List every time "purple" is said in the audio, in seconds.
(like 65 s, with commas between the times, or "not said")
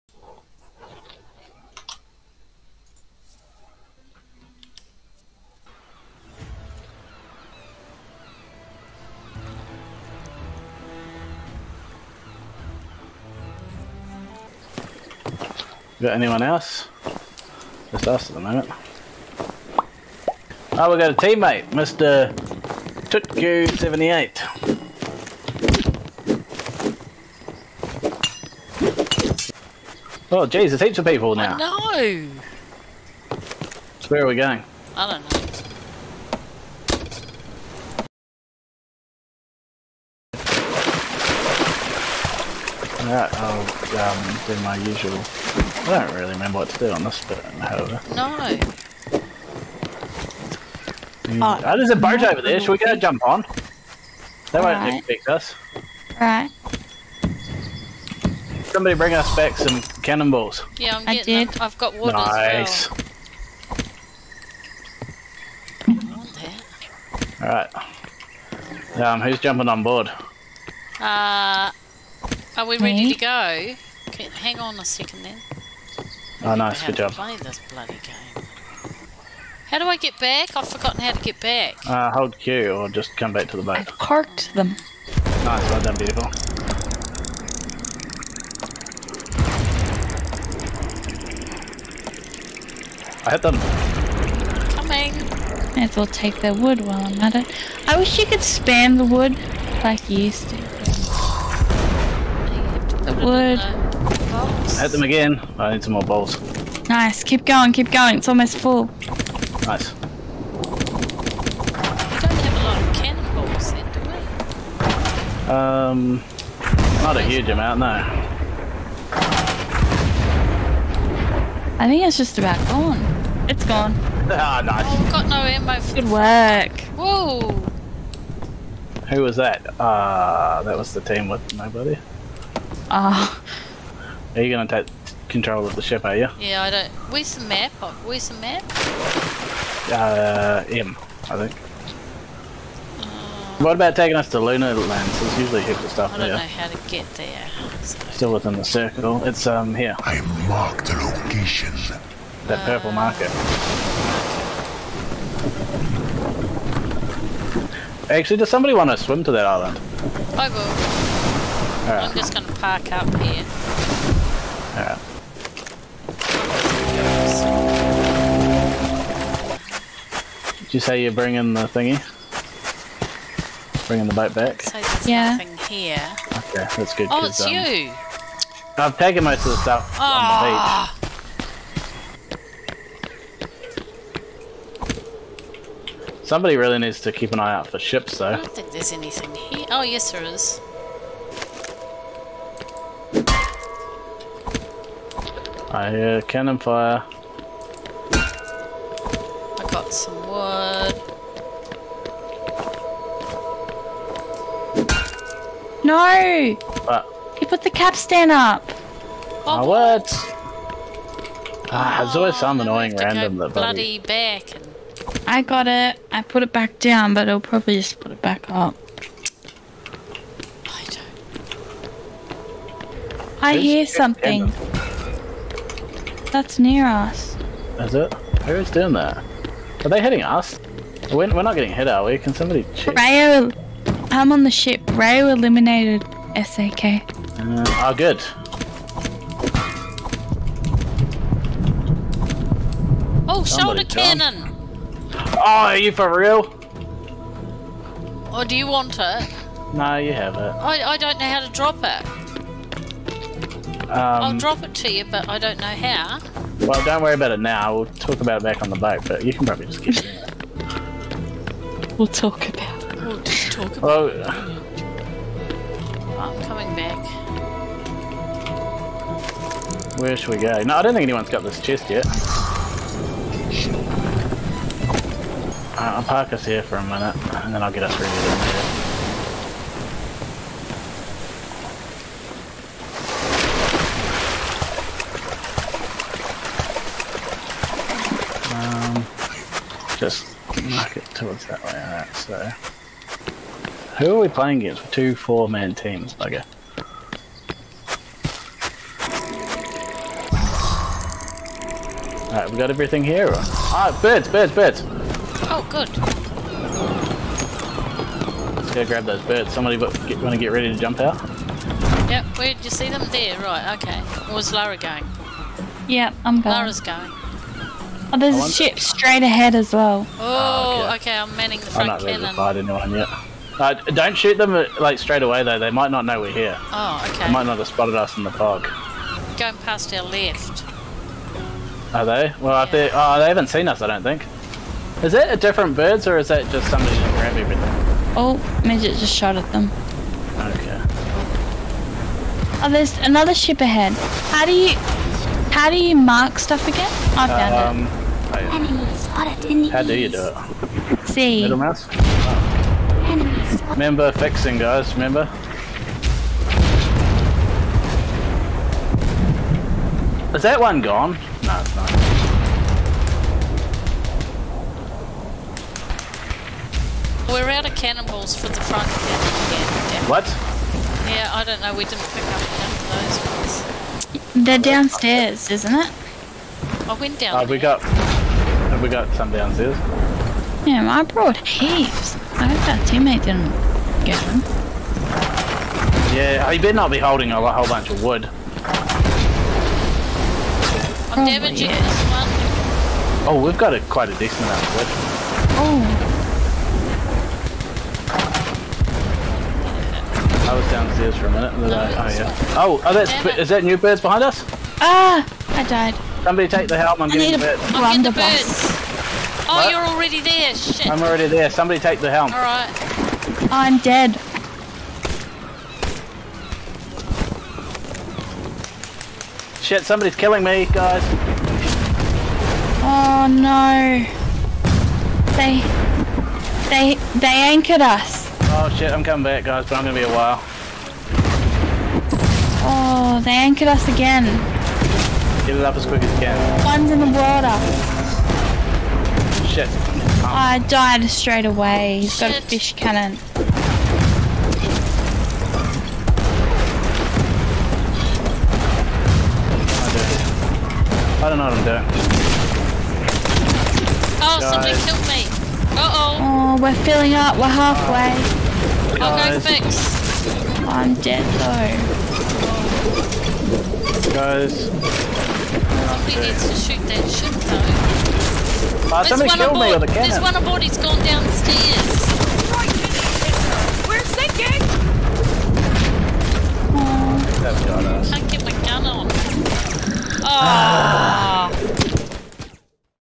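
152 s.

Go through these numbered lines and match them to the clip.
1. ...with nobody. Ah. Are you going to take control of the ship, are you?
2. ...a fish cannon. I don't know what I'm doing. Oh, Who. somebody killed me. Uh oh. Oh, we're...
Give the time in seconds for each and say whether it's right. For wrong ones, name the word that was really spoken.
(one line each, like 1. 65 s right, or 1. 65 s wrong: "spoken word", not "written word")
1. 131 s right
2. 442 s wrong: "Guys", not "Who".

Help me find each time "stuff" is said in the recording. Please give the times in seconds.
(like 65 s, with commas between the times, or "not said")
145 s, 179 s, 346 s.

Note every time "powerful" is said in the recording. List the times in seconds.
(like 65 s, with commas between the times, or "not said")
not said.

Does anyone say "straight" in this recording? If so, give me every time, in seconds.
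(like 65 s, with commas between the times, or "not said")
318 s, 324 s, 441 s.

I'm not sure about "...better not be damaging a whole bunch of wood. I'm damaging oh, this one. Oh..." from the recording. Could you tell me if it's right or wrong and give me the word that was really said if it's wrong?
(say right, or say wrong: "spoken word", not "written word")
wrong: "holding", not "damaging".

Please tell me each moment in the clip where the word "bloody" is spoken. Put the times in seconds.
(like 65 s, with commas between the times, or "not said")
77 s, 213 s.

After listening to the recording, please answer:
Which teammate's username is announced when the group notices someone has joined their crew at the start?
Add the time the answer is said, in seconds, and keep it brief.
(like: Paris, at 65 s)
Tutku78, at 21 s.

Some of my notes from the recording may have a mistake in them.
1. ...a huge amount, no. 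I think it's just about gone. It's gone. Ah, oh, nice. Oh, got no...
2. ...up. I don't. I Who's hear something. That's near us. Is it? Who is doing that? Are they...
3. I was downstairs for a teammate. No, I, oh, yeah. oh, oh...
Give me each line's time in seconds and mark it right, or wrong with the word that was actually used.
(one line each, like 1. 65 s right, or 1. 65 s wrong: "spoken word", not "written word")
1. 117 s right
2. 218 s right
3. 400 s wrong: "minute", not "teammate".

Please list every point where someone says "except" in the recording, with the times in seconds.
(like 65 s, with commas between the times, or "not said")
not said.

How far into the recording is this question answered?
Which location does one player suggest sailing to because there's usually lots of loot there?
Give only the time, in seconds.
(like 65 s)
144 s.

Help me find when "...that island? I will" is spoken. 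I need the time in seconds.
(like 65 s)
159 s.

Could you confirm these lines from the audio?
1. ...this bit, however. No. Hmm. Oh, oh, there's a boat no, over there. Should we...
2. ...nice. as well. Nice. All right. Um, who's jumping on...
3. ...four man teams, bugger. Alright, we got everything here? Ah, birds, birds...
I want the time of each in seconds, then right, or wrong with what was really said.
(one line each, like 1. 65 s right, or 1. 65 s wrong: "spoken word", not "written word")
1. 47 s right
2. 62 s right
3. 295 s right.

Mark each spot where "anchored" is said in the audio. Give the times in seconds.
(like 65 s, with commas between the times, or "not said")
427 s, 433 s.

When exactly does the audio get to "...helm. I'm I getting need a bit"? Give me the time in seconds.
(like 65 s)
406 s.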